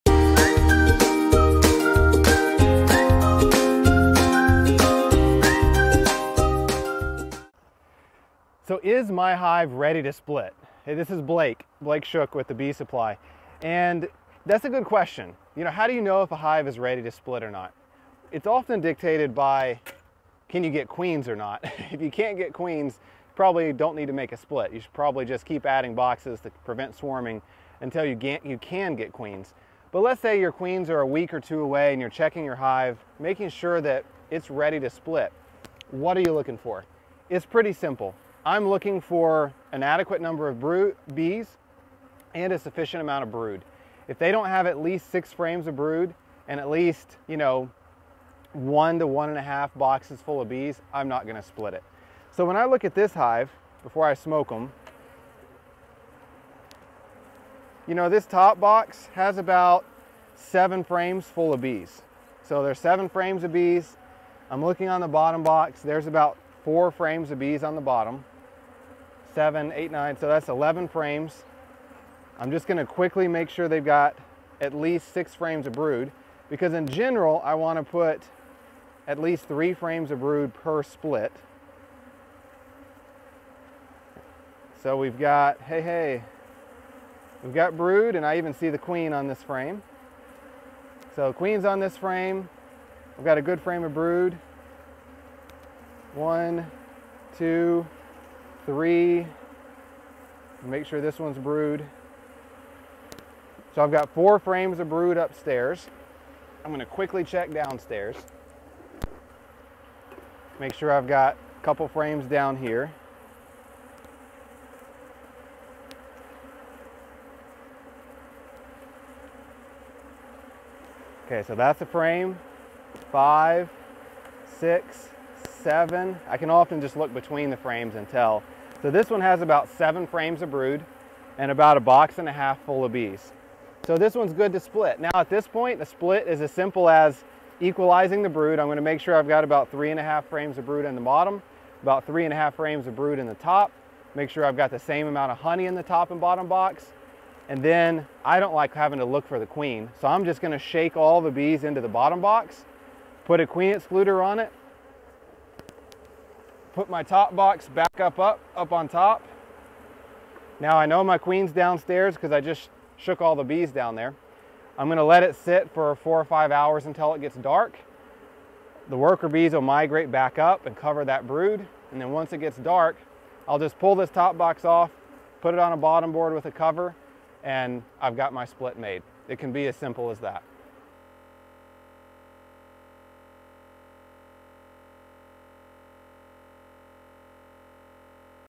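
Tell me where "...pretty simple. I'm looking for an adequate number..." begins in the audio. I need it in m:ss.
0:37.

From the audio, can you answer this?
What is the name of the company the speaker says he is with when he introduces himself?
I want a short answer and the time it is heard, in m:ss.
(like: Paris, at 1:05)
The Bee Supply, at 0:12.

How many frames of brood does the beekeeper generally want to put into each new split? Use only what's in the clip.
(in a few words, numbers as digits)
3.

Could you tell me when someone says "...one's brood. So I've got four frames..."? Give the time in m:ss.
1:41.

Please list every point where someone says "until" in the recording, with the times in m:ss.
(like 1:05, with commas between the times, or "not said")
0:27, 2:46.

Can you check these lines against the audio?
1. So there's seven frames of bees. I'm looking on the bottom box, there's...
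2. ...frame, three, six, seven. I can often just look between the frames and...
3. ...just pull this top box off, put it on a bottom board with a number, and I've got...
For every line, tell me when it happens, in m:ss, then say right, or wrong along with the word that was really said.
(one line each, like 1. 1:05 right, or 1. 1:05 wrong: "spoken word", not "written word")
1. 1:02 right
2. 2:01 wrong: "five", not "three"
3. 2:53 wrong: "cover", not "number".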